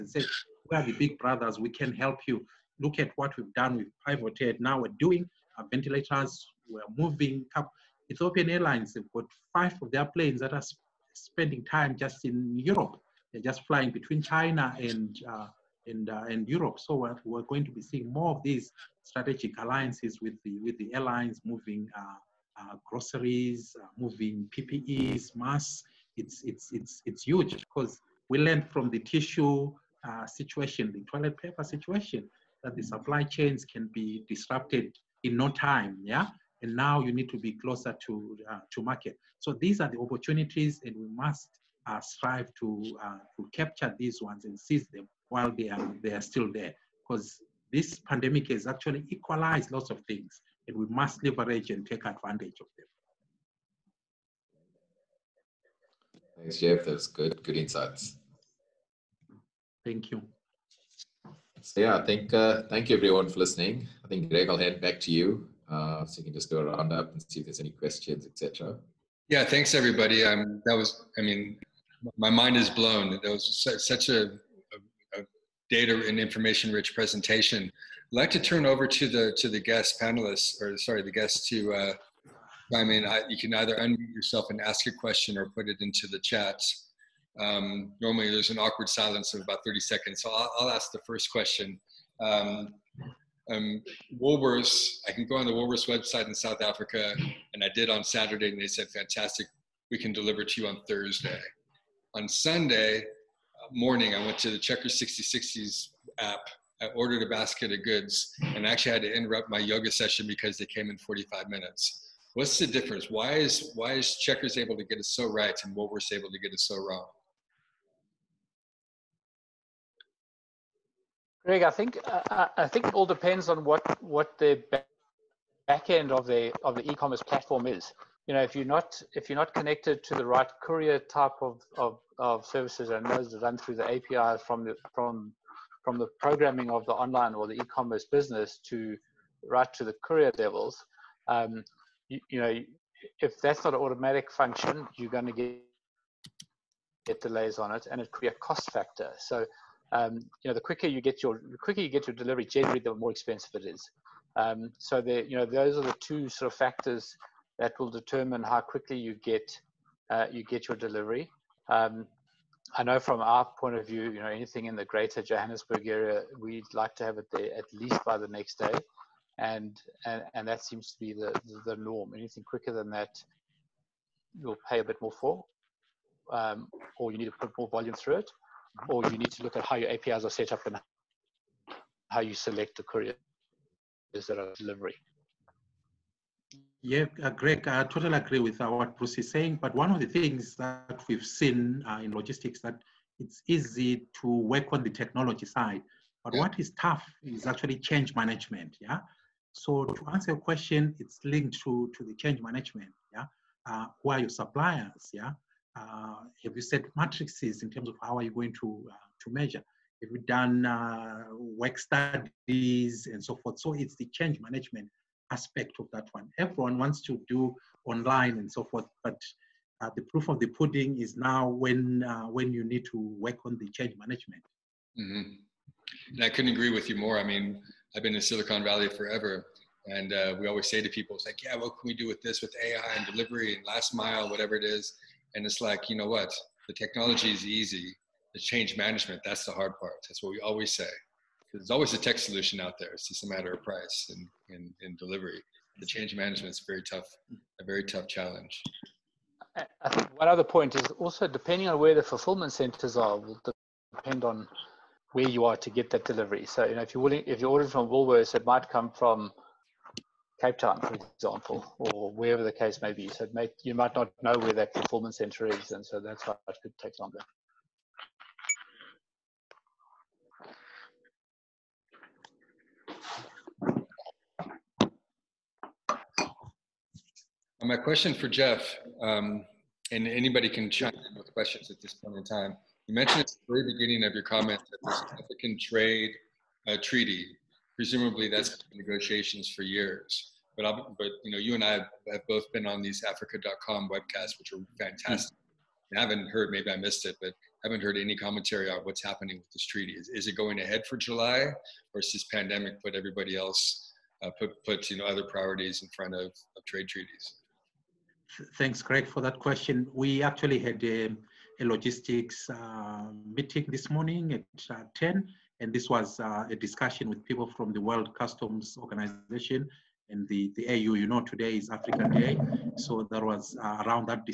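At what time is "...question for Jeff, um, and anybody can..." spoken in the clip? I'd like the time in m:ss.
4:37.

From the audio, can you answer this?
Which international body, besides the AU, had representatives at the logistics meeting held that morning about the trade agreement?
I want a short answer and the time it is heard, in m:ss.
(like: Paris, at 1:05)
World Customs Organization, at 5:17.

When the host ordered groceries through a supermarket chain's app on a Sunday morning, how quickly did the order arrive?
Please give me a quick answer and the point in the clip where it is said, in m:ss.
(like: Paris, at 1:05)
45 minutes, at 1:50.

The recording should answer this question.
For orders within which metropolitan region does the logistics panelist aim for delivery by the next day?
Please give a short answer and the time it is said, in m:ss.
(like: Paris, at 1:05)
Greater Johannesburg, at 2:44.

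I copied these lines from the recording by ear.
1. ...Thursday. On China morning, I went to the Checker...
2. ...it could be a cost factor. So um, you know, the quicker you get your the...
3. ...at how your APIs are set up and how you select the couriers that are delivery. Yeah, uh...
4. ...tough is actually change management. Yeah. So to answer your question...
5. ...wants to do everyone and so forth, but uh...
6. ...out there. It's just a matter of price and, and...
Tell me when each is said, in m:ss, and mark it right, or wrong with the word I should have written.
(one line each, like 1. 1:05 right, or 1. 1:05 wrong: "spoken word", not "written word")
1. 1:40 wrong: "Sunday", not "China"
2. 2:28 right
3. 2:59 right
4. 3:16 right
5. 3:36 wrong: "online", not "everyone"
6. 4:02 right.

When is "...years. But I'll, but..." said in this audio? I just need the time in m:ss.
4:49.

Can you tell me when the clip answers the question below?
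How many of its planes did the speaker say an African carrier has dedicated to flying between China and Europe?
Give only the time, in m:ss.
0:09.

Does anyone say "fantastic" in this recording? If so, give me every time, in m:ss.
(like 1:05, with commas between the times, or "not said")
1:38, 4:54.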